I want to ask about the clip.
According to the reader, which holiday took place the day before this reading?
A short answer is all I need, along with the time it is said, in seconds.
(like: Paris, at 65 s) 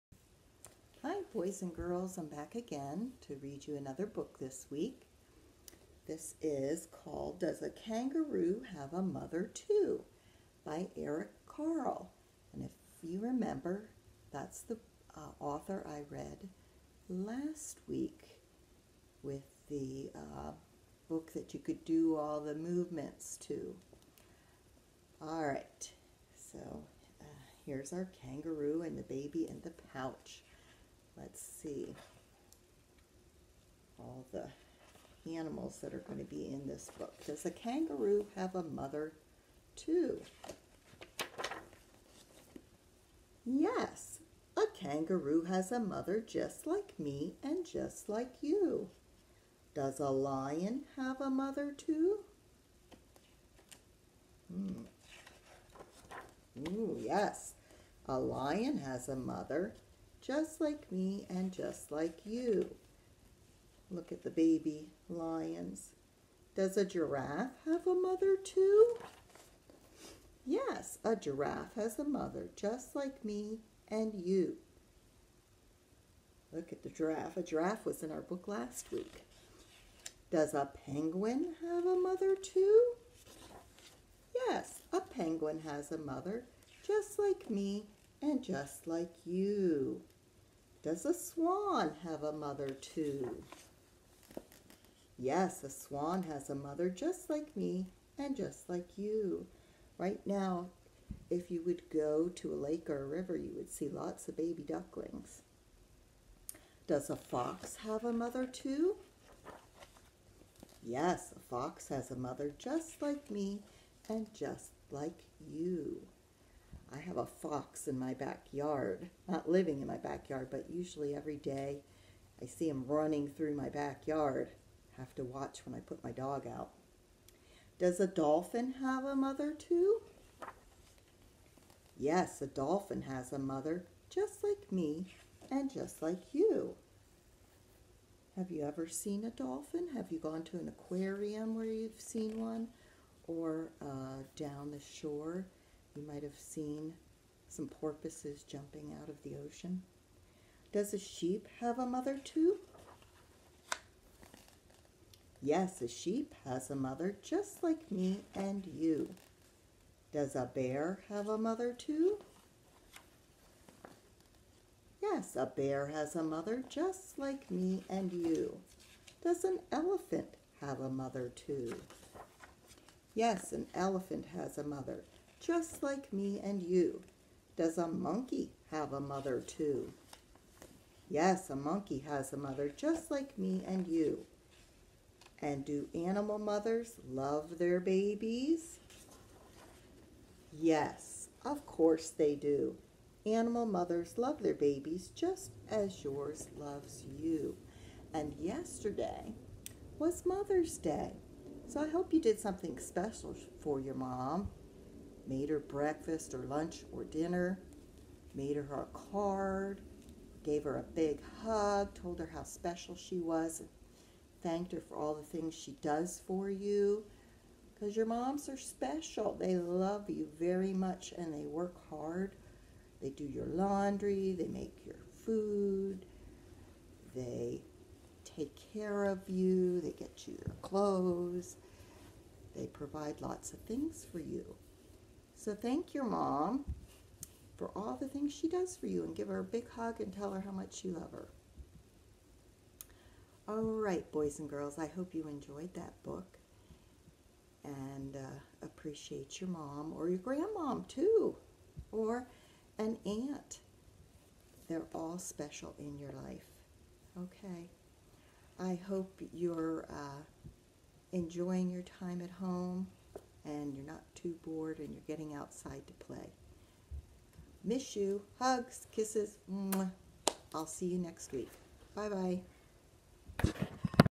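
Mother's Day, at 200 s.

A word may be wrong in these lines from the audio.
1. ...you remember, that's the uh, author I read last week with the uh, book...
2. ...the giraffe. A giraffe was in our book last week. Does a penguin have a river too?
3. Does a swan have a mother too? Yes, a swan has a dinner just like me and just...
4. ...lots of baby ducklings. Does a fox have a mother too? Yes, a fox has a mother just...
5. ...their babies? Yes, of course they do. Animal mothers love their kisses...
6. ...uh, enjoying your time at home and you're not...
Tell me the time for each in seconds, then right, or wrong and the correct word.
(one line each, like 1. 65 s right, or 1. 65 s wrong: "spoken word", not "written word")
1. 13 s right
2. 76 s wrong: "mother", not "river"
3. 90 s wrong: "mother", not "dinner"
4. 103 s right
5. 187 s wrong: "babies", not "kisses"
6. 259 s right.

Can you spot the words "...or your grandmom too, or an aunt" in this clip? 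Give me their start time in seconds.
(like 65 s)
249 s.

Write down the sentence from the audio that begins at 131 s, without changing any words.
Yes, a dolphin has a mother, just like me and just like you.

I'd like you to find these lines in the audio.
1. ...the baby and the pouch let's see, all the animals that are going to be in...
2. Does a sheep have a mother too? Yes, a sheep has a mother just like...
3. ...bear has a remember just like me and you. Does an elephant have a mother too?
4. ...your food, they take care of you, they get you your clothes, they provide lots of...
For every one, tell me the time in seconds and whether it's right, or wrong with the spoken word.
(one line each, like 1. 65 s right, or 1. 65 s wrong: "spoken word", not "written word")
1. 28 s right
2. 150 s right
3. 165 s wrong: "mother", not "remember"
4. 224 s right.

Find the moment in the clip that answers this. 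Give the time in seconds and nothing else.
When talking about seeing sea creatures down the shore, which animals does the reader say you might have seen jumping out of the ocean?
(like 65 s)
147 s.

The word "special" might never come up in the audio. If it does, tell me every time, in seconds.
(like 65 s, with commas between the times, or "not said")
202 s, 212 s, 218 s, 255 s.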